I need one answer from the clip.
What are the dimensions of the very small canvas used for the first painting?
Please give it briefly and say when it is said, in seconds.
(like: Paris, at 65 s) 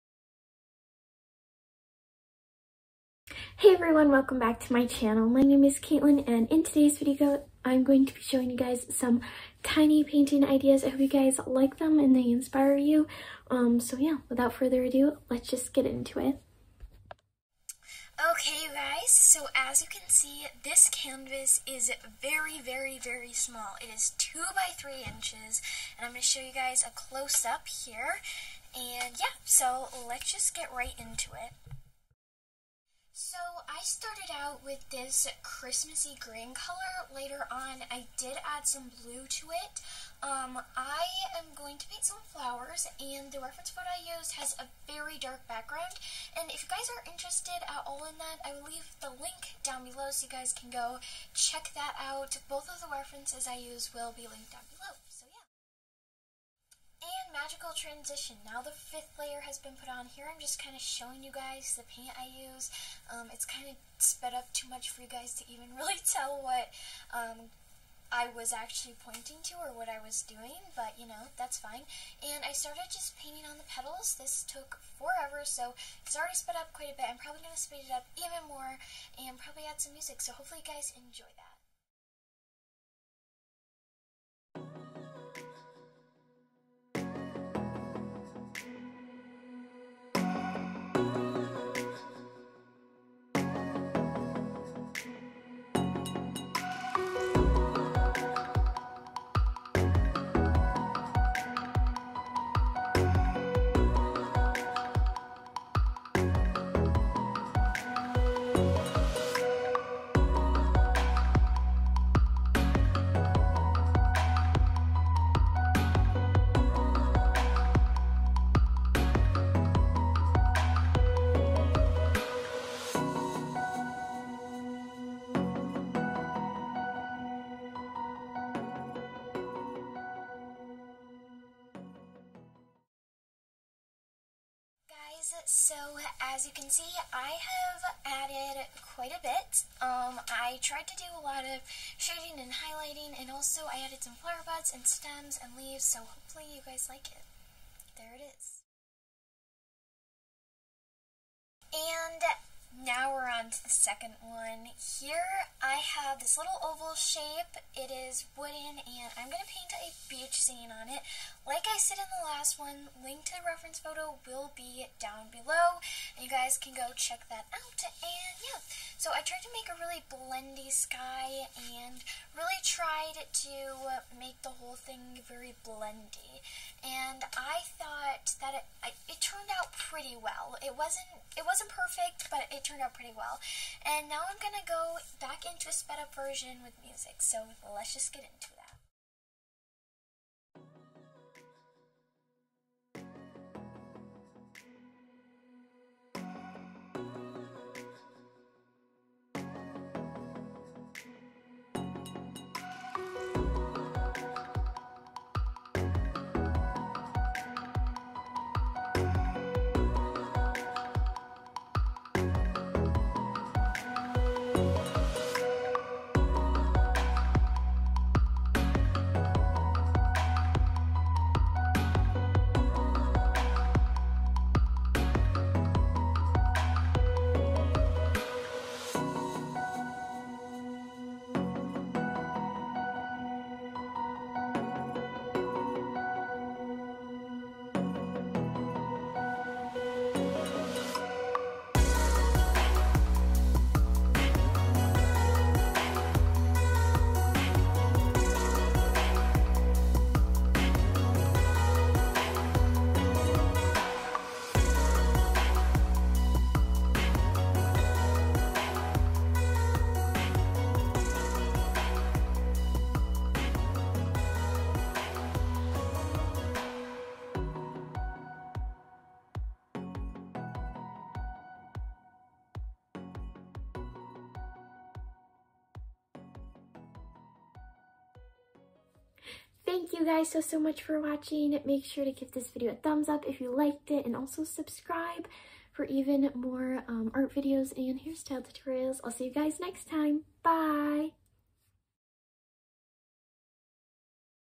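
2 by 3 inches, at 24 s.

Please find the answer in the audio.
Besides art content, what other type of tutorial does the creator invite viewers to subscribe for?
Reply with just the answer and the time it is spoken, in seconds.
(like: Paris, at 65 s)
hairstyle tutorials, at 288 s.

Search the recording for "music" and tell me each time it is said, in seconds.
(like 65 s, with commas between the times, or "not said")
79 s, 186 s.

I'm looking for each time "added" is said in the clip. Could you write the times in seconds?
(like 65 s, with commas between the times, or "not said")
138 s, 143 s.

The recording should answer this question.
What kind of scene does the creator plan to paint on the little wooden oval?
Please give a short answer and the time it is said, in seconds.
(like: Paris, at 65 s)
beach scene, at 160 s.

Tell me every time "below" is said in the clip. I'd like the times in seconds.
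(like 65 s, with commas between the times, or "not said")
49 s, 165 s.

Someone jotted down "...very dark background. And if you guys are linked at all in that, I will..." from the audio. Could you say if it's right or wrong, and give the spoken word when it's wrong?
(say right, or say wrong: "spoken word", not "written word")
wrong: "interested", not "linked".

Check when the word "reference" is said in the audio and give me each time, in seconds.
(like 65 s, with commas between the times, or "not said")
43 s, 52 s, 163 s.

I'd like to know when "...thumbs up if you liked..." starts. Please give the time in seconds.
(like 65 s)
282 s.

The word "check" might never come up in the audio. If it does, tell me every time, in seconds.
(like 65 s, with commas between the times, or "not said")
51 s, 166 s.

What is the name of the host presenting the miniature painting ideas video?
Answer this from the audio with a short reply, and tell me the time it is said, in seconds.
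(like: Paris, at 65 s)
Katelyn, at 5 s.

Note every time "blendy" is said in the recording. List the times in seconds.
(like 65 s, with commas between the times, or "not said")
170 s, 175 s.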